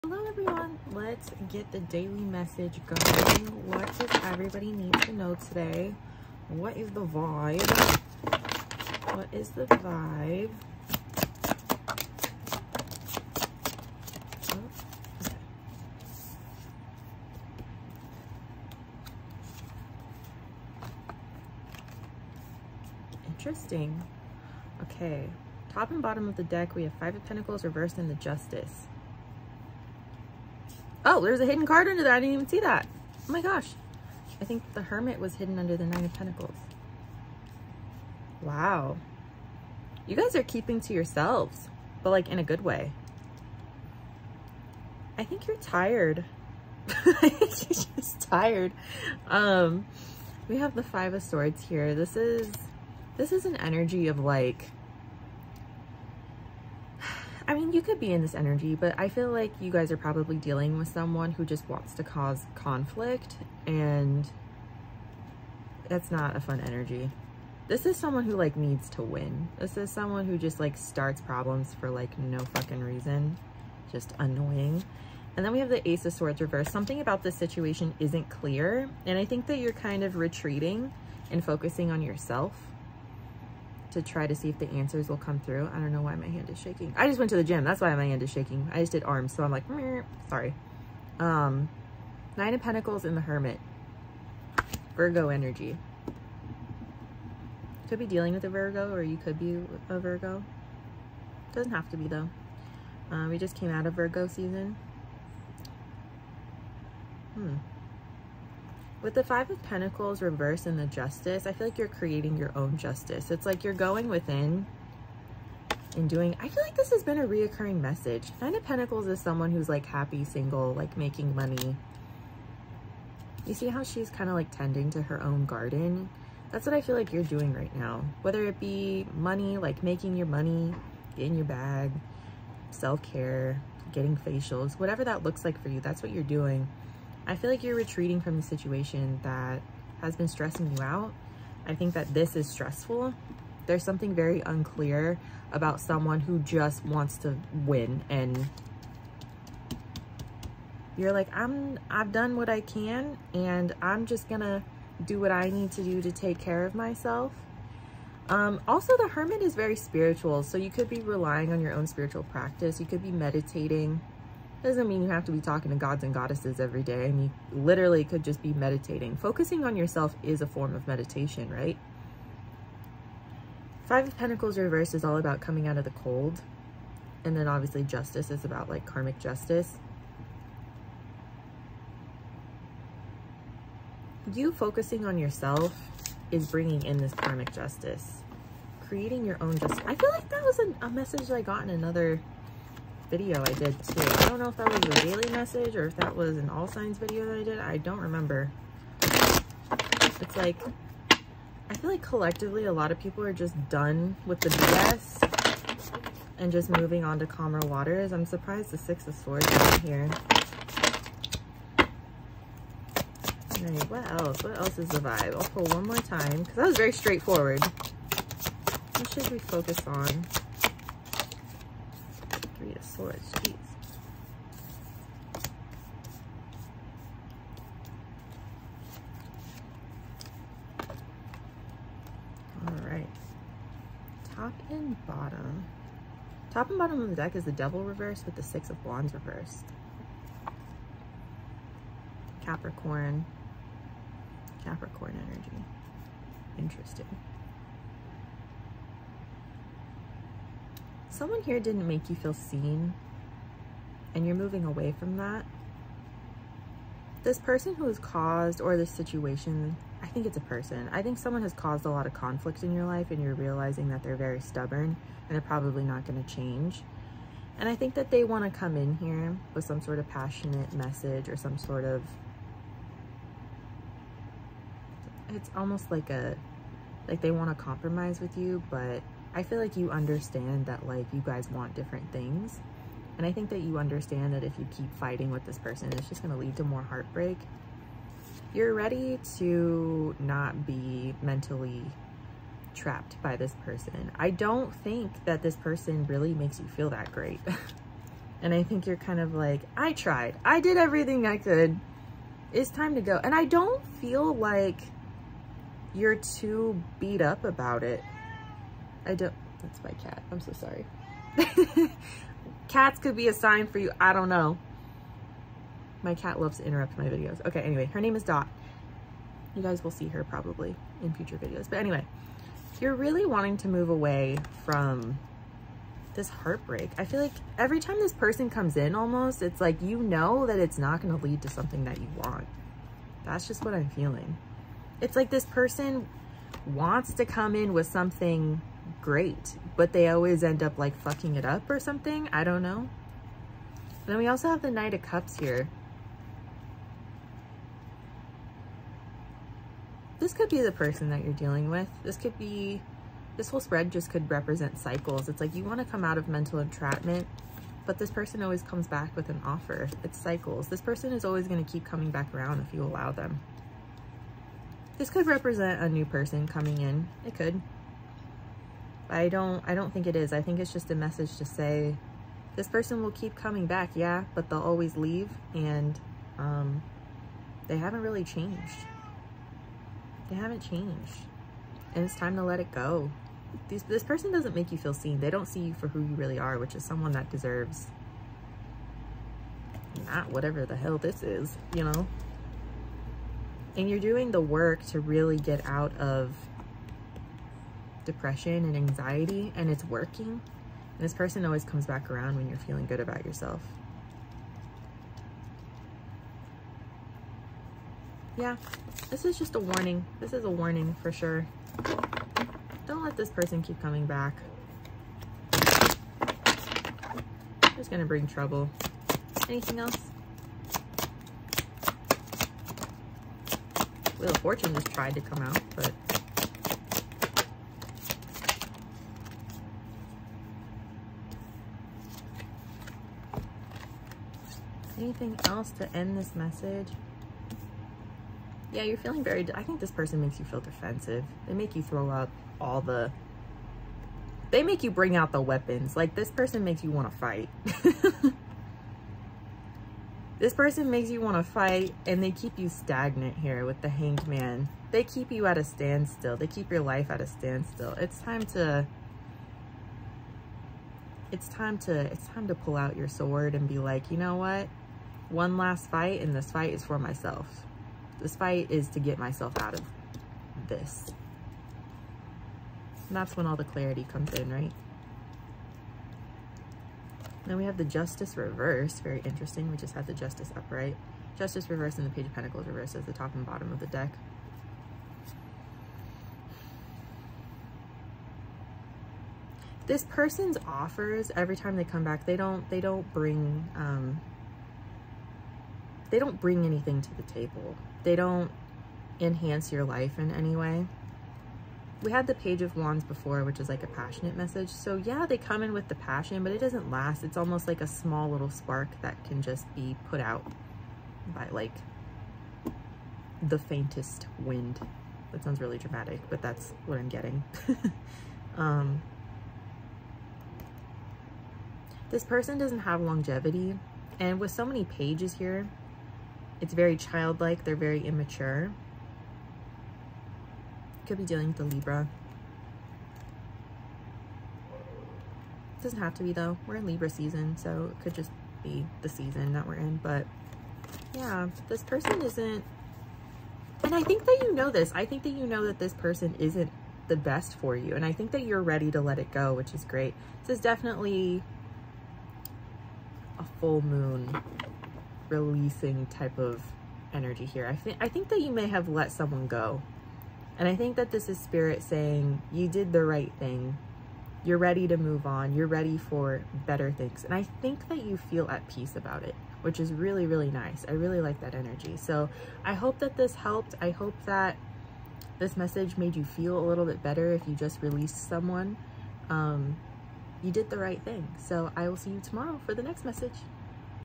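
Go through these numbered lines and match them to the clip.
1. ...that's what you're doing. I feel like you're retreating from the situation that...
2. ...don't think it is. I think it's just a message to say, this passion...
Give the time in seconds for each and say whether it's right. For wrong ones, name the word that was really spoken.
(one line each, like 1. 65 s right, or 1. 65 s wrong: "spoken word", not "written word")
1. 135 s right
2. 369 s wrong: "person", not "passion".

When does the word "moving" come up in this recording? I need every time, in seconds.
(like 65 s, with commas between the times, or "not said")
206 s, 254 s.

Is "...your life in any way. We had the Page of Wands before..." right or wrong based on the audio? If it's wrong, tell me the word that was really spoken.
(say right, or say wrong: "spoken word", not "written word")
right.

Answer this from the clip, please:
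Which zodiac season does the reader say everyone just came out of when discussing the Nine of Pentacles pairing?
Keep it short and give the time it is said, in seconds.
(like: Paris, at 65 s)
Virgo season, at 103 s.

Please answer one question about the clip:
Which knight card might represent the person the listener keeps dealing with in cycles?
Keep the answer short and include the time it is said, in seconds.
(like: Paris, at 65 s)
Knight of Cups, at 344 s.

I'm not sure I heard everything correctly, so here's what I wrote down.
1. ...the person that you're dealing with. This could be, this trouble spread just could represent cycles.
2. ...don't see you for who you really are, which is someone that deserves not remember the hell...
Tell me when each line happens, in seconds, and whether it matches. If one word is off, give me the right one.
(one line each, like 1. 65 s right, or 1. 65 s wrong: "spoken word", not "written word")
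1. 350 s wrong: "whole", not "trouble"
2. 385 s wrong: "whatever", not "remember".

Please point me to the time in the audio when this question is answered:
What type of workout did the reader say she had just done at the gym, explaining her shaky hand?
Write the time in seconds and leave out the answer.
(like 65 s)
89 s.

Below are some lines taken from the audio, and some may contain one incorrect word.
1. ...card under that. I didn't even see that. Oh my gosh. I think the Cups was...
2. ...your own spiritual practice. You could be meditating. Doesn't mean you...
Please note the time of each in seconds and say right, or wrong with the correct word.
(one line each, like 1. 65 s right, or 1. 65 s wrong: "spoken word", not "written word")
1. 31 s wrong: "Hermit", not "Cups"
2. 161 s right.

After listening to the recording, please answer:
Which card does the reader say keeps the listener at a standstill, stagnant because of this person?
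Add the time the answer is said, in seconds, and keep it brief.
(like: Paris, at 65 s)
The Hanged Man, at 453 s.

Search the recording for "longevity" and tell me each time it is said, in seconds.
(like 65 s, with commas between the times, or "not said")
522 s.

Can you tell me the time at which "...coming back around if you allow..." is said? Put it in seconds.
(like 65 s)
361 s.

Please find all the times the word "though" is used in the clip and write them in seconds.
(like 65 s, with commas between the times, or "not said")
102 s, 536 s.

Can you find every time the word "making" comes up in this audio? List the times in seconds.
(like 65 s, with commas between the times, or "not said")
120 s, 129 s.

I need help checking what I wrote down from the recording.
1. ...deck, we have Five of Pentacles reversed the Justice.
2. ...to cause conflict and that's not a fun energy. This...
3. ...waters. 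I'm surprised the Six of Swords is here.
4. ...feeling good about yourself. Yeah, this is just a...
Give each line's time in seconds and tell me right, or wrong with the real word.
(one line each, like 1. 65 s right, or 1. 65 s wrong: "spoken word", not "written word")
1. 26 s right
2. 61 s right
3. 207 s right
4. 402 s right.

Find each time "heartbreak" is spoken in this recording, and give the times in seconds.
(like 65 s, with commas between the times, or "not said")
286 s, 326 s.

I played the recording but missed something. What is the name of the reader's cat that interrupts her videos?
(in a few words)
Dot.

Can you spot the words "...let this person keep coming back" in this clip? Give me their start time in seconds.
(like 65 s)
413 s.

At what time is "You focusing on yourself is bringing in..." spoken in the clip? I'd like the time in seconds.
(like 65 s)
184 s.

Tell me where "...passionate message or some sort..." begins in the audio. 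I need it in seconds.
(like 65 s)
270 s.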